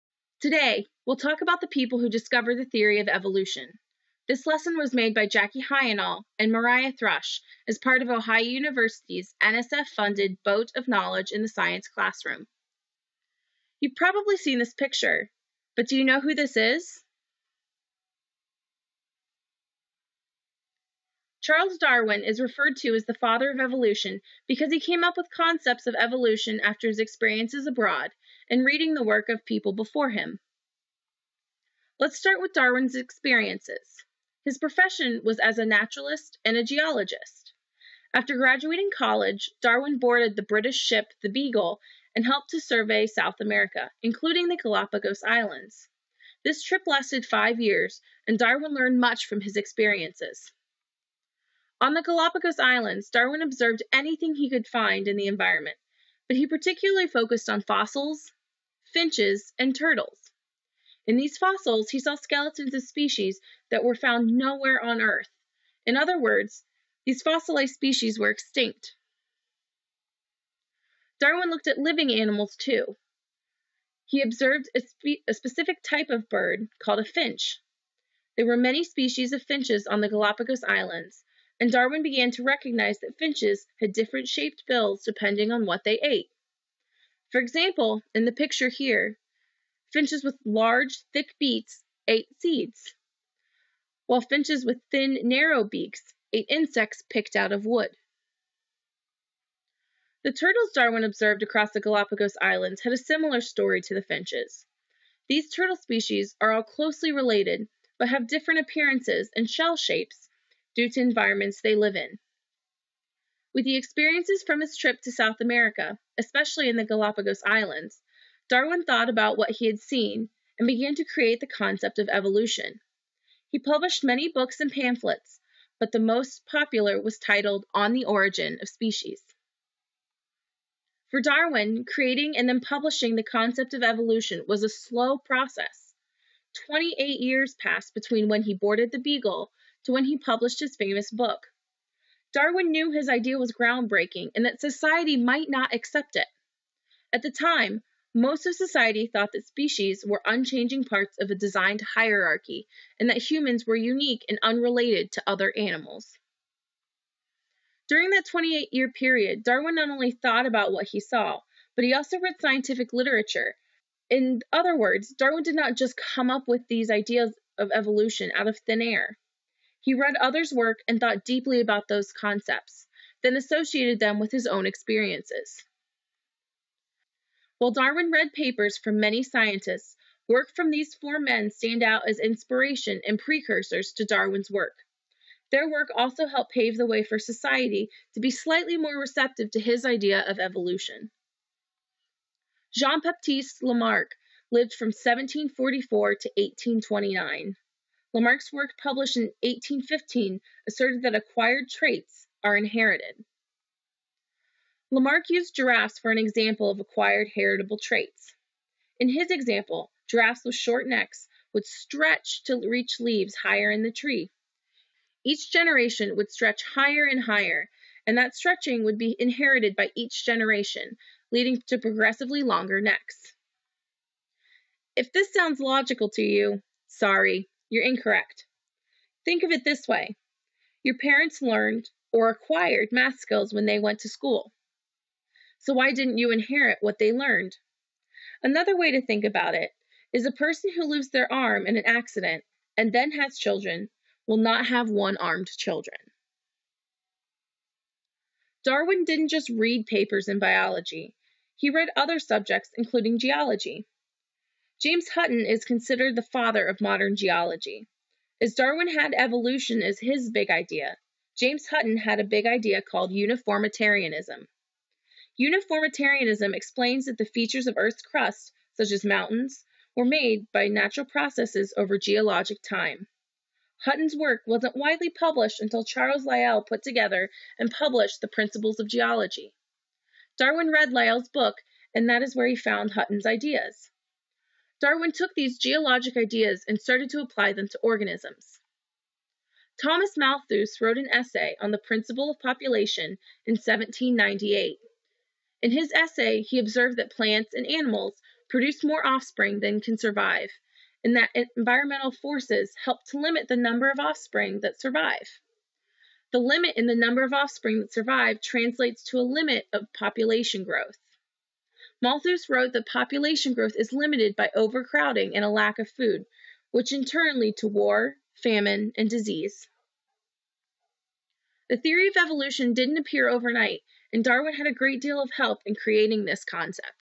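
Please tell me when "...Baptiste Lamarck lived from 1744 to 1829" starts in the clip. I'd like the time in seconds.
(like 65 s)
192 s.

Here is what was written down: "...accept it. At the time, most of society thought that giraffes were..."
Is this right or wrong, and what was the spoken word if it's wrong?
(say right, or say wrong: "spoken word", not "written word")
wrong: "species", not "giraffes".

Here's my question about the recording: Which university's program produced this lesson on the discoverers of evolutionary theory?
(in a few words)
Ohio University.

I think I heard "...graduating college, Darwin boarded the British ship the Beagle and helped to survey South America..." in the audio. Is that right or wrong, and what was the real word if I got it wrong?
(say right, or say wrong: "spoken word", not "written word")
right.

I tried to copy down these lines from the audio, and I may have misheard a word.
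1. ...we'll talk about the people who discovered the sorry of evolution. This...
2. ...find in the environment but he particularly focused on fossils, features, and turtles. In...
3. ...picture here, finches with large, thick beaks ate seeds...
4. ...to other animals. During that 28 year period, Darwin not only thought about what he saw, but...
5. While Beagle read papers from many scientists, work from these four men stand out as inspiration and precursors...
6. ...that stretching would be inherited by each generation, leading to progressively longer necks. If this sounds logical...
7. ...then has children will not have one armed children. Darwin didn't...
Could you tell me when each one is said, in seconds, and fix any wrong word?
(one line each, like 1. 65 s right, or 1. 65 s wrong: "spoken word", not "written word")
1. 1 s wrong: "theory", not "sorry"
2. 54 s wrong: "finches", not "features"
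3. 88 s right
4. 155 s right
5. 177 s wrong: "Darwin", not "Beagle"
6. 218 s right
7. 242 s right.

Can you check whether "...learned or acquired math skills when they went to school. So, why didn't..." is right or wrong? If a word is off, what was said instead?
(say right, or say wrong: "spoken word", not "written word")
right.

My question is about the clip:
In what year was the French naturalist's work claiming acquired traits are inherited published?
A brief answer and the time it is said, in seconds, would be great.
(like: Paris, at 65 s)
1815, at 199 s.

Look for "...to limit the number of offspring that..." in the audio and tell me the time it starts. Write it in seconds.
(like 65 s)
303 s.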